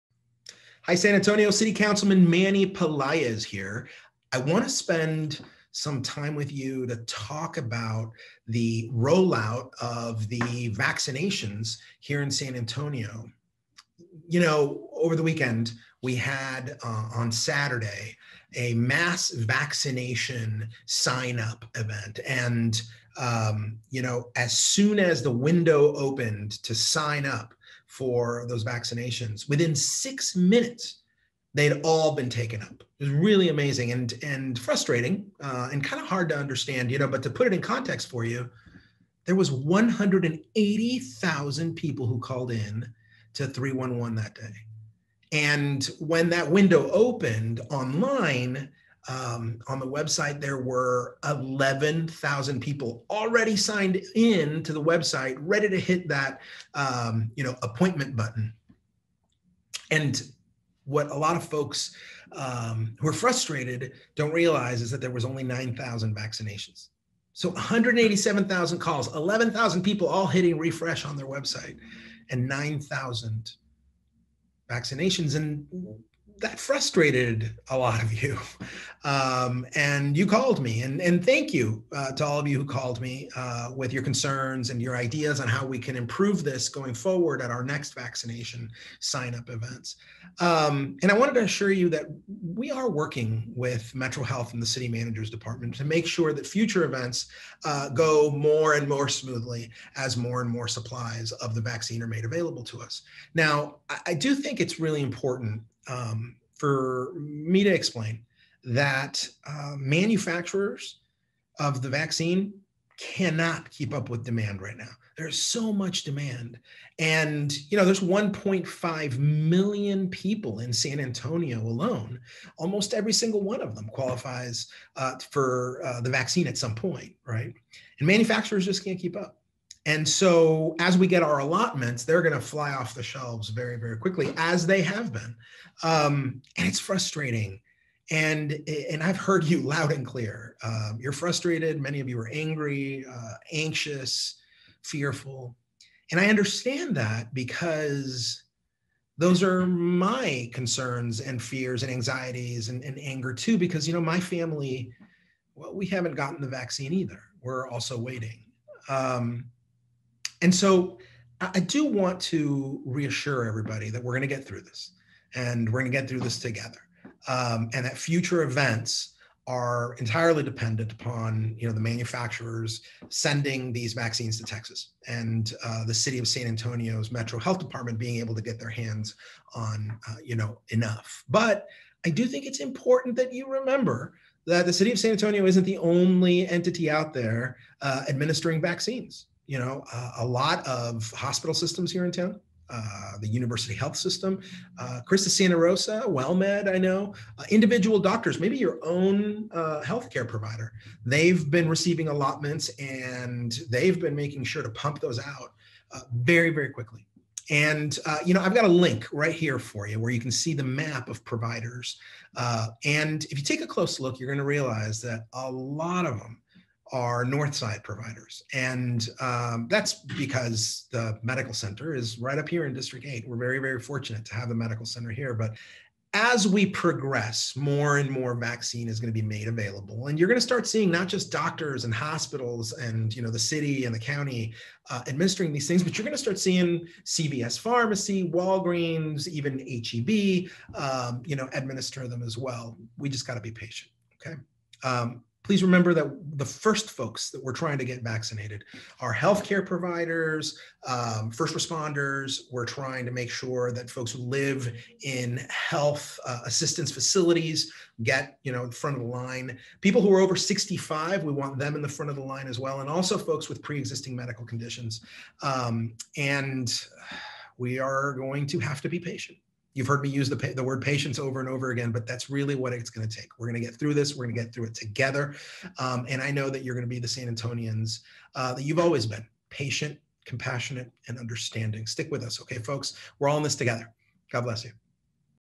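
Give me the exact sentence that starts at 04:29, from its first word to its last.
You've heard me use the, the word patience over and over again, but that's really what it's going to take.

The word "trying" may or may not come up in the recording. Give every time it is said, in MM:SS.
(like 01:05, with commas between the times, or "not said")
04:07, 04:12.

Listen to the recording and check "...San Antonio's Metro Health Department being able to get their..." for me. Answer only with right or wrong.
right.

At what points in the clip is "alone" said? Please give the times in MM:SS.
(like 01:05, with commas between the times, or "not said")
02:01.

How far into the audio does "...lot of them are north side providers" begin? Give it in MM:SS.
03:35.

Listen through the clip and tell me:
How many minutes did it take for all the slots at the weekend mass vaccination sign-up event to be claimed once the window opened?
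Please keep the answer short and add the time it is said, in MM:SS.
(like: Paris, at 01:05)
6, at 00:29.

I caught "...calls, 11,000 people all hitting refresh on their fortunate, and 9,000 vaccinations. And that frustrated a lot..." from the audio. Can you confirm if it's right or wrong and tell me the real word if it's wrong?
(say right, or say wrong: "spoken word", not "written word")
wrong: "website", not "fortunate".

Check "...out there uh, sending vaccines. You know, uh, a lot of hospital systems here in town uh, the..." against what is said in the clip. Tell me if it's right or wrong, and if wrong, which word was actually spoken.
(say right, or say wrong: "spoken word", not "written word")
wrong: "administering", not "sending".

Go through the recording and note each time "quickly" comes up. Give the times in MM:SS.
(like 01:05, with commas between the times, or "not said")
02:13, 03:26.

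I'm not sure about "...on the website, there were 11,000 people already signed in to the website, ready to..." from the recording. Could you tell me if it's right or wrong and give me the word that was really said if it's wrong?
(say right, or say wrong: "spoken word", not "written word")
right.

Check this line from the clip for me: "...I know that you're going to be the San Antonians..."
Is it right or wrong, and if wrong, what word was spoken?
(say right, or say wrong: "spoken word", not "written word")
right.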